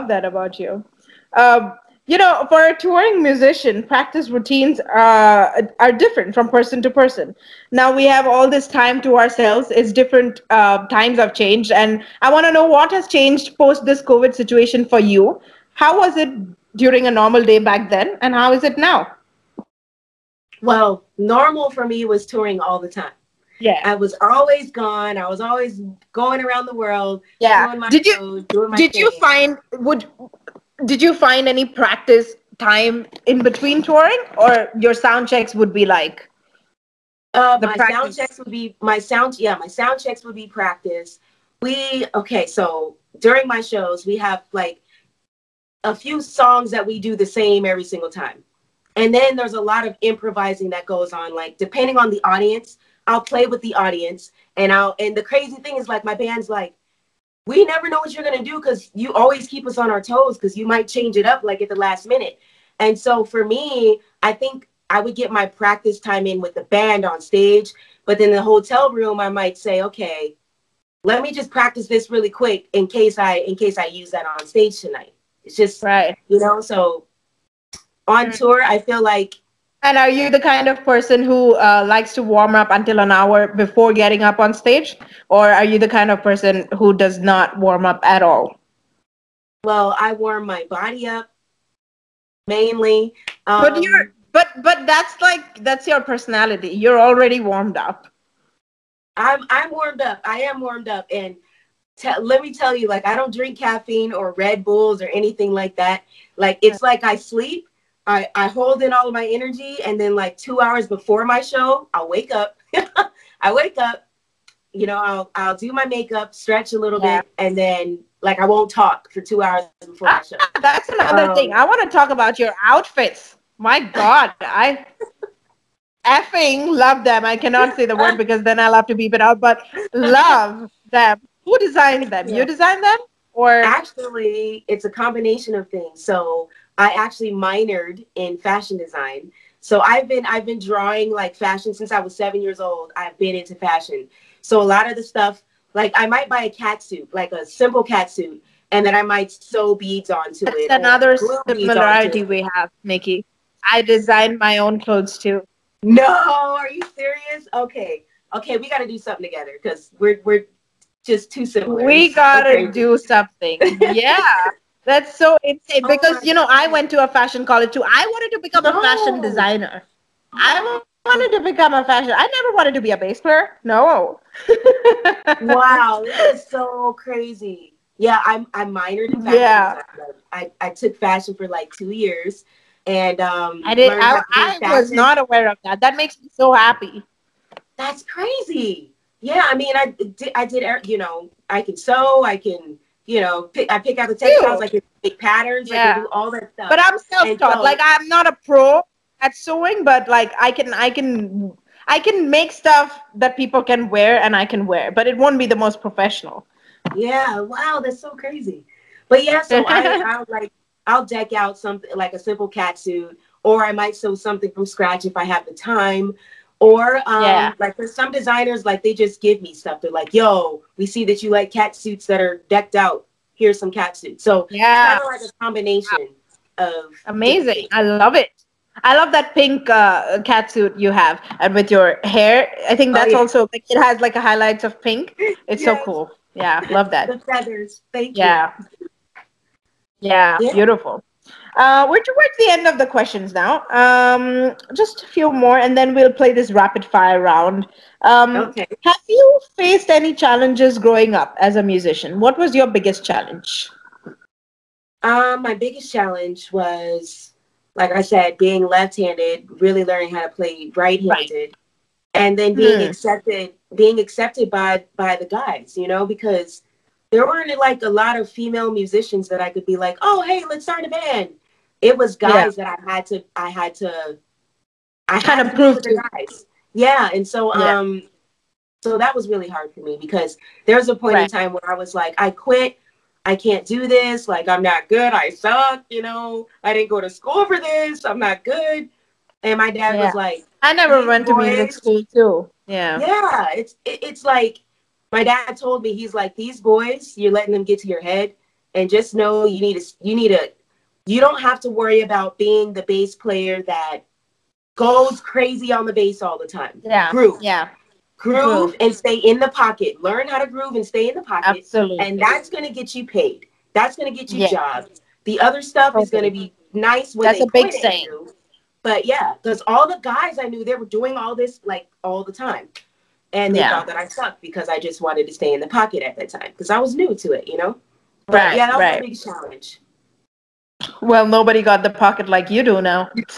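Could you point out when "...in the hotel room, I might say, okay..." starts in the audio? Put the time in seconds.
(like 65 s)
68 s.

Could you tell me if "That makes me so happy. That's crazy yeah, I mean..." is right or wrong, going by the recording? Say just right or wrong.
right.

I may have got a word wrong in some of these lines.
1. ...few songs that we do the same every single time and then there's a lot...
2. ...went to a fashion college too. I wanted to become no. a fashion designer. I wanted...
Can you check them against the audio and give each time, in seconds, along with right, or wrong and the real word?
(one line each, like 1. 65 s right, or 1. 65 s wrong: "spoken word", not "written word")
1. 45 s right
2. 166 s right.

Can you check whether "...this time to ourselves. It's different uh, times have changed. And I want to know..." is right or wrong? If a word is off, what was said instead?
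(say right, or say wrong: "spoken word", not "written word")
right.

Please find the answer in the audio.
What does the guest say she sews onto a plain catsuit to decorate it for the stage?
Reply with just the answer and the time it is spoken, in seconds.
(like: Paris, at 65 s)
Beads, at 149 s.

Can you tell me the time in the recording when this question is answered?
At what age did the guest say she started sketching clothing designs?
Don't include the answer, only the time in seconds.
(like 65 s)
142 s.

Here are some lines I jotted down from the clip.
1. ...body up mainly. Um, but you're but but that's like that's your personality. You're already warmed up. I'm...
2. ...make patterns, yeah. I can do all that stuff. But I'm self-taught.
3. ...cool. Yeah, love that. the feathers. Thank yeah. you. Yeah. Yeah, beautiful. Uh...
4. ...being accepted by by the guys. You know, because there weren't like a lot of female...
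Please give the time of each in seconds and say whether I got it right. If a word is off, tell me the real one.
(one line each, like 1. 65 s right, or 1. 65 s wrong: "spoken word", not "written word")
1. 90 s right
2. 195 s right
3. 235 s right
4. 263 s right.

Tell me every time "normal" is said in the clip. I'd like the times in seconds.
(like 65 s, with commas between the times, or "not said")
17 s, 21 s.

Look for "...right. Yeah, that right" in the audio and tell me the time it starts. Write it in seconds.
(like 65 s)
328 s.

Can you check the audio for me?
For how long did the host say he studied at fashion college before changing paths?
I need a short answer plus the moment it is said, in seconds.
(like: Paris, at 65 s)
2 years, at 181 s.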